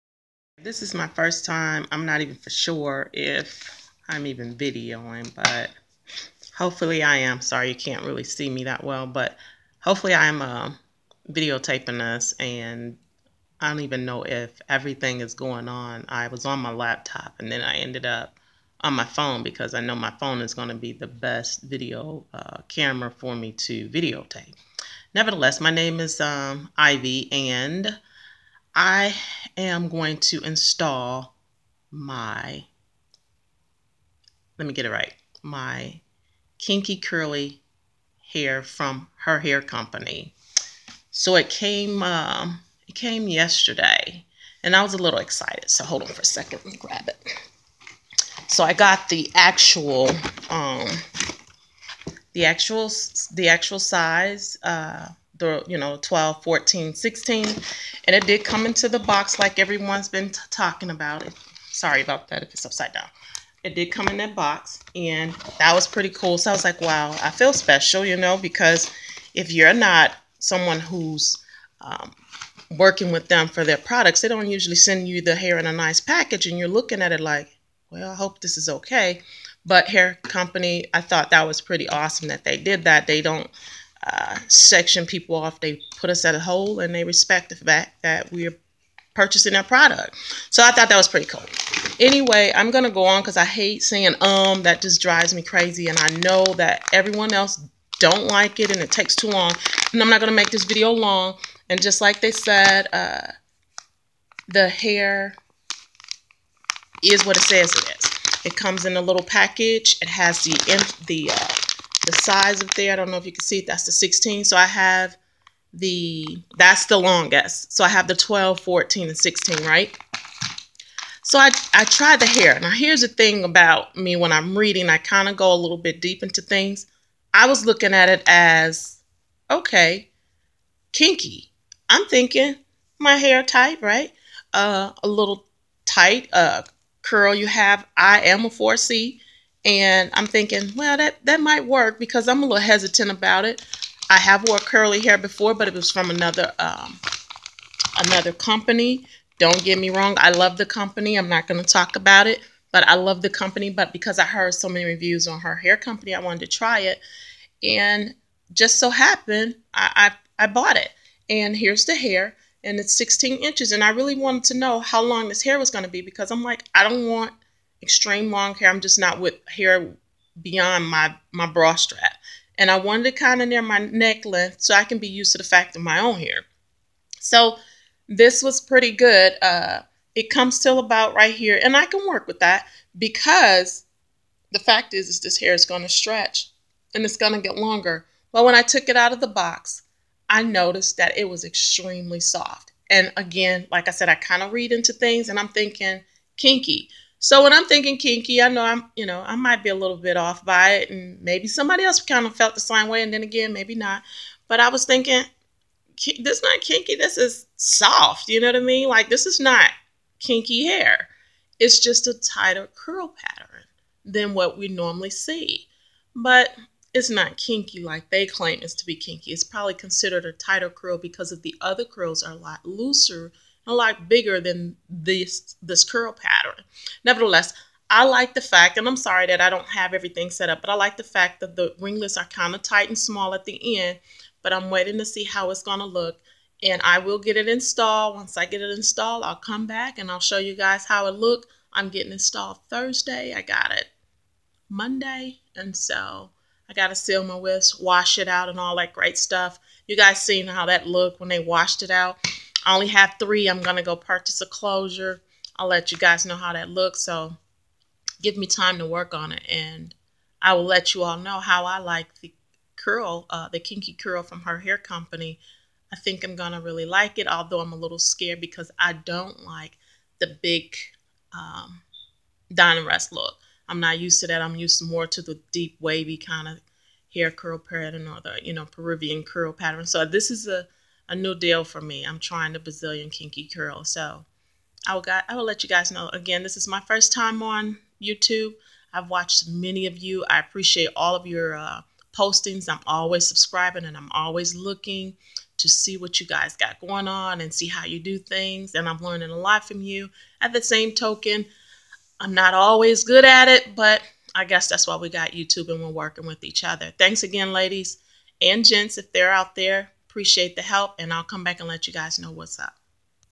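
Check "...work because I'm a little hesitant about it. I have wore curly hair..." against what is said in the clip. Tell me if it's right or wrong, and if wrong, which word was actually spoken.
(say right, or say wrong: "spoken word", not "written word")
right.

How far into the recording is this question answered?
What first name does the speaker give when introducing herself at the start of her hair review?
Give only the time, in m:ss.
0:26.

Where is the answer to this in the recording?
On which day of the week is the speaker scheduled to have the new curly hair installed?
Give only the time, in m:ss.
4:02.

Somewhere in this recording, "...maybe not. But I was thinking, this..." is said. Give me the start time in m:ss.
3:23.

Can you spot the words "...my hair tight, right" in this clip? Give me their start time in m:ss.
2:12.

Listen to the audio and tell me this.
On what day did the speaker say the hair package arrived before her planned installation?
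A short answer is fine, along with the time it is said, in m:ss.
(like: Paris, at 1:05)
Monday, at 4:04.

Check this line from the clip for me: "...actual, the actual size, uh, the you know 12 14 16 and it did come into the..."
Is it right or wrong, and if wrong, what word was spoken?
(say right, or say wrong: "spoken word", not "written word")
right.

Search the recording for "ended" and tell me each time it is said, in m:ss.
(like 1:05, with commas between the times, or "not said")
0:17.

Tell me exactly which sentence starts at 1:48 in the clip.
It comes in a little package.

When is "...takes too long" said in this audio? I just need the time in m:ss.
1:38.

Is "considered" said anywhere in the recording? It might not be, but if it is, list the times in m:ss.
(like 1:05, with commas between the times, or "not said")
3:39.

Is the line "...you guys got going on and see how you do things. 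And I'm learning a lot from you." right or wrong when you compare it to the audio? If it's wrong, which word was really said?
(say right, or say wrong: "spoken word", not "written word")
right.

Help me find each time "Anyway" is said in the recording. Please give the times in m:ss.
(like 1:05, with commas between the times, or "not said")
1:31.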